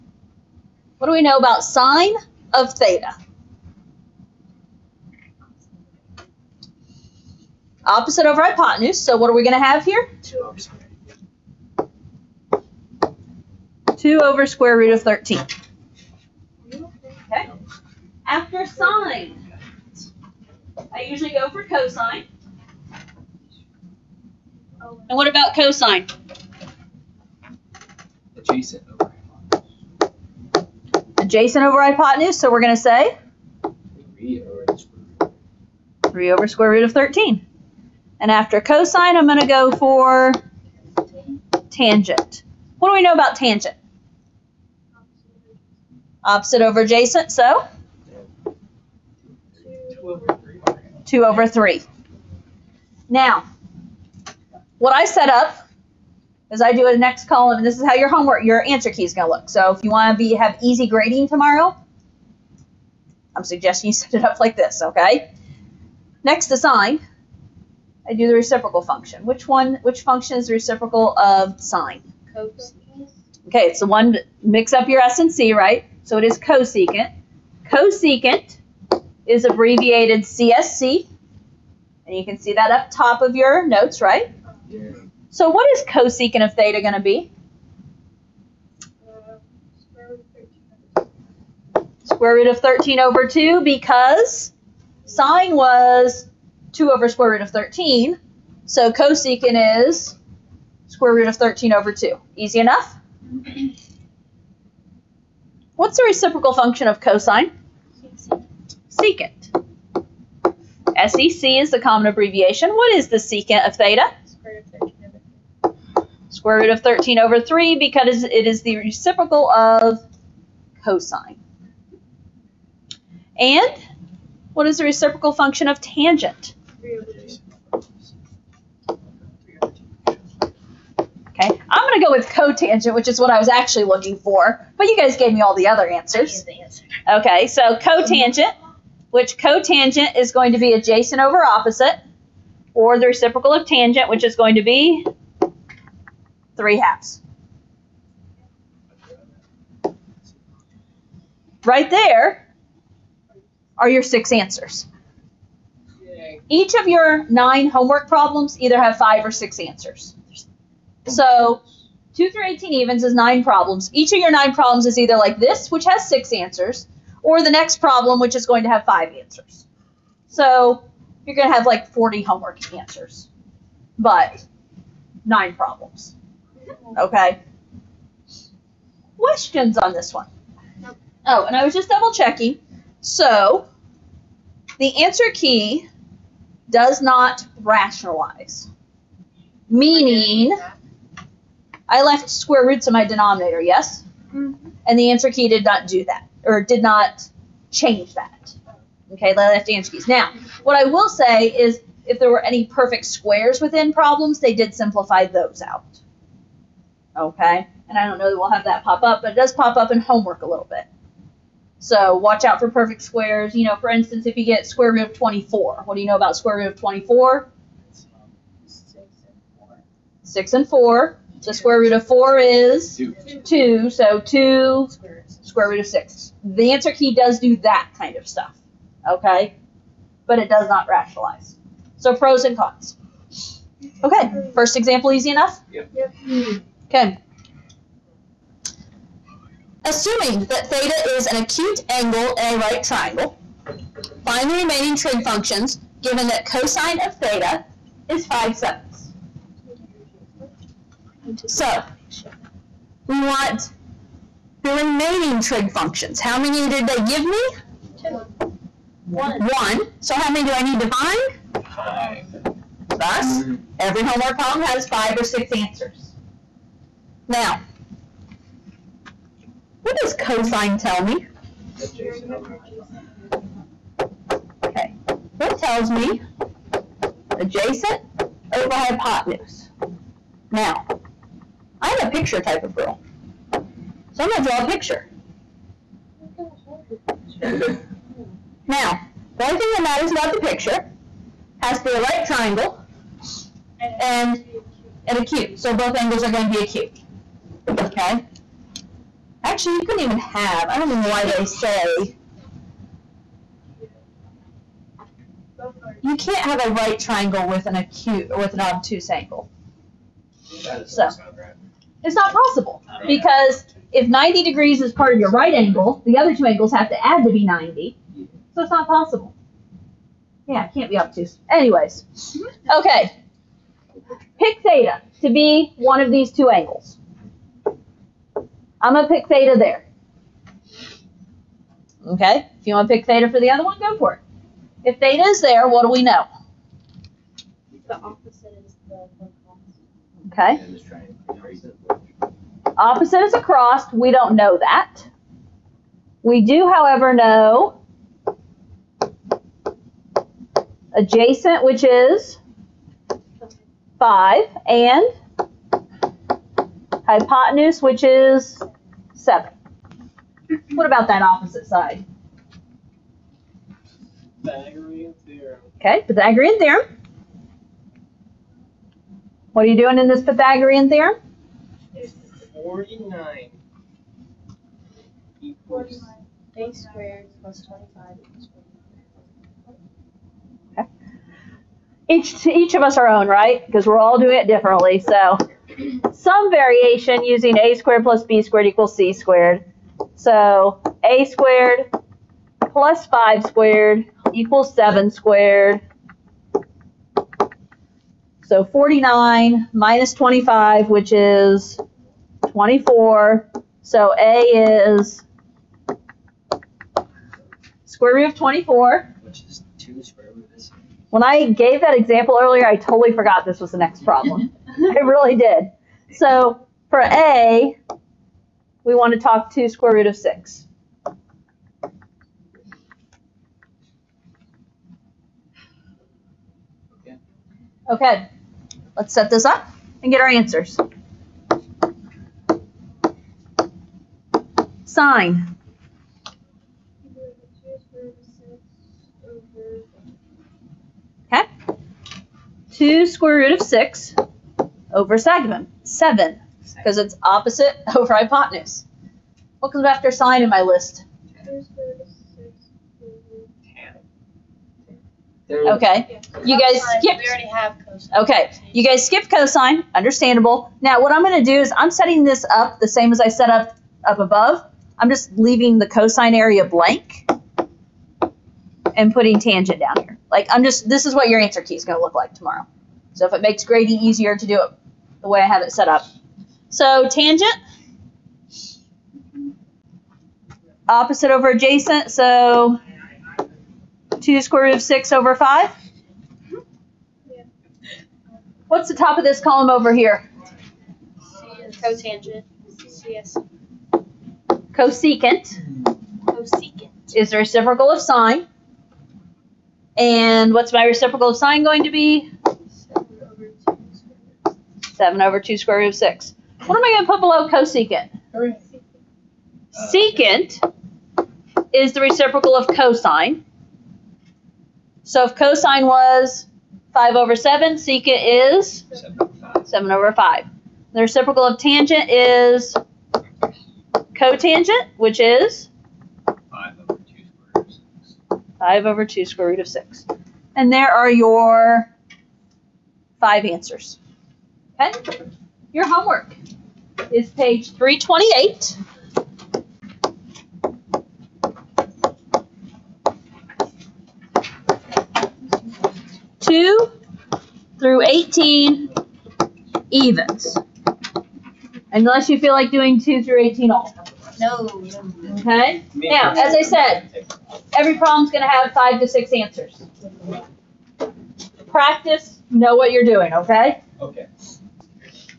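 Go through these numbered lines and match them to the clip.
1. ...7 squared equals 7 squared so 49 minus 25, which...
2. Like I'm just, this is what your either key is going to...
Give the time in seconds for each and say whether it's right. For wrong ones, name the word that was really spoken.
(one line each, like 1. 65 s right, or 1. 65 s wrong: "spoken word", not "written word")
1. 393 s wrong: "5", not "7"
2. 470 s wrong: "answer", not "either".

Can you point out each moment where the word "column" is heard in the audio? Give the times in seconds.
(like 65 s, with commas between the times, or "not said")
57 s, 489 s.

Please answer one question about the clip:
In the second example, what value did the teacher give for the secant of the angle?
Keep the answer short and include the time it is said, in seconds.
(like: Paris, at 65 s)
7/5, at 517 s.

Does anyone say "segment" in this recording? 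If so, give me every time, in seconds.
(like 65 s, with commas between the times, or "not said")
445 s.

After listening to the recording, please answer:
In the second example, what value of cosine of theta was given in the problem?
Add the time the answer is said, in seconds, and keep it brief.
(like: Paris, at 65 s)
5/7, at 248 s.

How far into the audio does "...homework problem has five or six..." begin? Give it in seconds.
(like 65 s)
264 s.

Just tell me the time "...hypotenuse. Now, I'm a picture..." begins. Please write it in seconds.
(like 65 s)
278 s.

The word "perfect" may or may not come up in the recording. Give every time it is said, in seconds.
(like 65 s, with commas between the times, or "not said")
202 s, 212 s.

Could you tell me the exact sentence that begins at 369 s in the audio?
What are you doing in this Pythagorean theorem?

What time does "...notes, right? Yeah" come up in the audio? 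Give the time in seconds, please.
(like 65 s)
83 s.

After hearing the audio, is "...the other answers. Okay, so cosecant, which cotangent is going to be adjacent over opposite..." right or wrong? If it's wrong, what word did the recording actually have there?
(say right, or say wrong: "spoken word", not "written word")
wrong: "cotangent", not "cosecant".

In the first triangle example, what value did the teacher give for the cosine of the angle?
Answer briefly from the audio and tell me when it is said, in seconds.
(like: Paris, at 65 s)
3 over square root of 13, at 36 s.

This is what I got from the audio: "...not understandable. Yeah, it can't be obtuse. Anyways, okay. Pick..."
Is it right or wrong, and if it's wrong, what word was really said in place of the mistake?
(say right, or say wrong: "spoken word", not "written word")
wrong: "possible", not "understandable".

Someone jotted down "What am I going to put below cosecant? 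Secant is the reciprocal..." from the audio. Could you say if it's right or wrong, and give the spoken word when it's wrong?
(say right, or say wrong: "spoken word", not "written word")
right.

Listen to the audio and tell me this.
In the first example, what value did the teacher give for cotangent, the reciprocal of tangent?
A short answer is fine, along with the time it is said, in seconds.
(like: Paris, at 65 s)
3 halves, at 146 s.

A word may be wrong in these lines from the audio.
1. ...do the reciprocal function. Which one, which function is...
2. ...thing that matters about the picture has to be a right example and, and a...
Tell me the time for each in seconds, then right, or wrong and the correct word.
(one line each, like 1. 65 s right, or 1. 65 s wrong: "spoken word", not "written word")
1. 68 s right
2. 289 s wrong: "triangle", not "example".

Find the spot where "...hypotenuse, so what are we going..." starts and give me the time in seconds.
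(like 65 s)
8 s.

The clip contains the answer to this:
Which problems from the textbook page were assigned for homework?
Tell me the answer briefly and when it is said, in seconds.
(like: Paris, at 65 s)
2 through 18 evens, at 546 s.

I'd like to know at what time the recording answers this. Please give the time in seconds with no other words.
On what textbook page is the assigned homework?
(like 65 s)
537 s.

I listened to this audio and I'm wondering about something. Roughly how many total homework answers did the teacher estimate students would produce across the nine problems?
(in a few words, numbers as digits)
40.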